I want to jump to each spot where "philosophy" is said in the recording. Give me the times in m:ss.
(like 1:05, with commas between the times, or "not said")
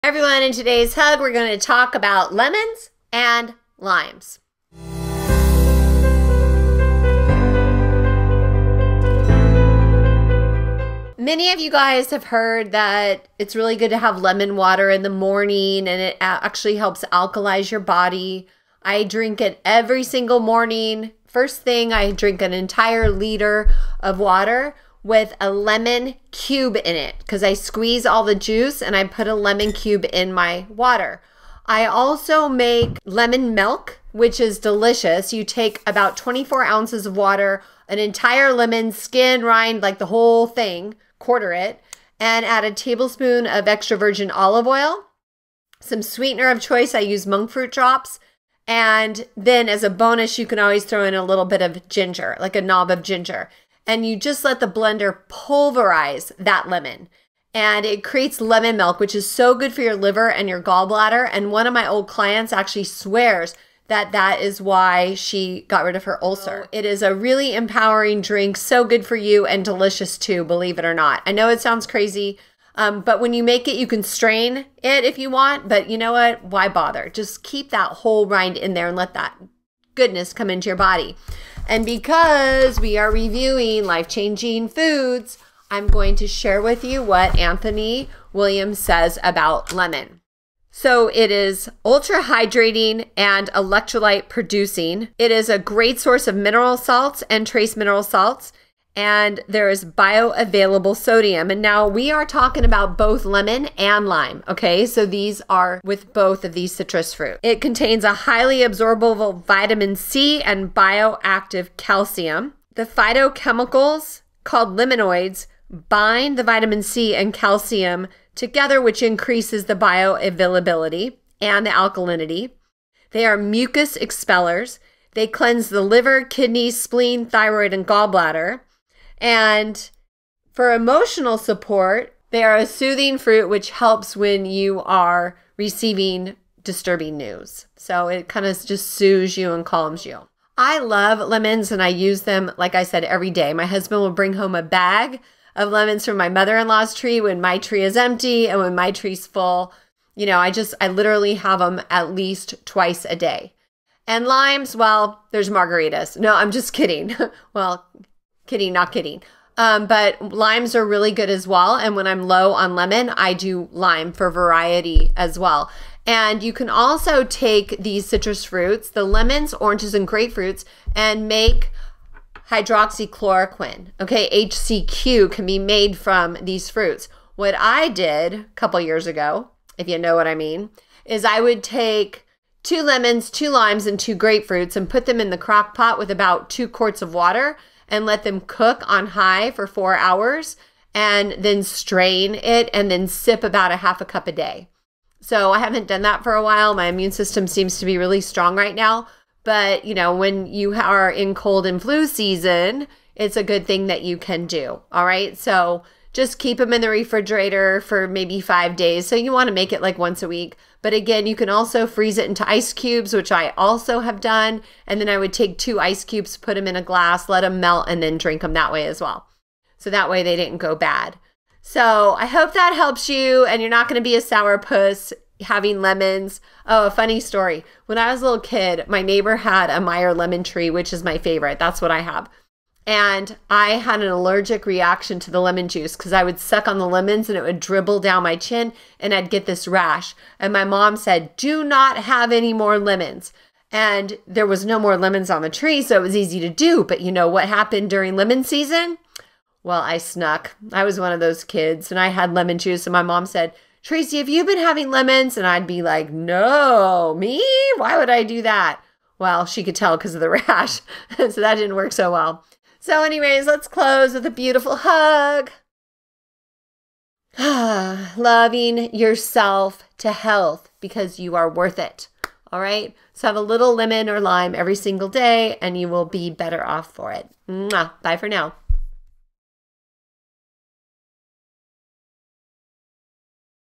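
not said.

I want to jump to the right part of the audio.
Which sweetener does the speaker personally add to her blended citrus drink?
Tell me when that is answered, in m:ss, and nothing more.
0:47.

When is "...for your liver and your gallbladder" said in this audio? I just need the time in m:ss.
0:59.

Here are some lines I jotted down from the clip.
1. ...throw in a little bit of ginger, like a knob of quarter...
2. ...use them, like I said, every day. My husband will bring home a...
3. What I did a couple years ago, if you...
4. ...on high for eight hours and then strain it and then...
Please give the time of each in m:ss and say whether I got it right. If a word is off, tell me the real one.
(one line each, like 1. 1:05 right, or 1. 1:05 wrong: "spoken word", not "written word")
1. 0:50 wrong: "ginger", not "quarter"
2. 2:21 right
3. 2:57 right
4. 3:08 wrong: "four", not "eight".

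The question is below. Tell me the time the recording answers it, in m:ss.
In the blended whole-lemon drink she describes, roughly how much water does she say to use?
0:36.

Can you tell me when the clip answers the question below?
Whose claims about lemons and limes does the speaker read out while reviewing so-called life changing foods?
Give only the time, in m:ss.
1:27.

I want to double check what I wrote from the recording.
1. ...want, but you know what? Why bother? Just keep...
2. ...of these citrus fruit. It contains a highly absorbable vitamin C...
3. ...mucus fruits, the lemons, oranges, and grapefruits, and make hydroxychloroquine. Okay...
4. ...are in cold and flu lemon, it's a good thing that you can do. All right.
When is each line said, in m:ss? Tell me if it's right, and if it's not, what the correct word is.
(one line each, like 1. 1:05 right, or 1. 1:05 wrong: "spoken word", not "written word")
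1. 1:15 right
2. 1:46 right
3. 2:48 wrong: "citrus", not "mucus"
4. 3:20 wrong: "season", not "lemon".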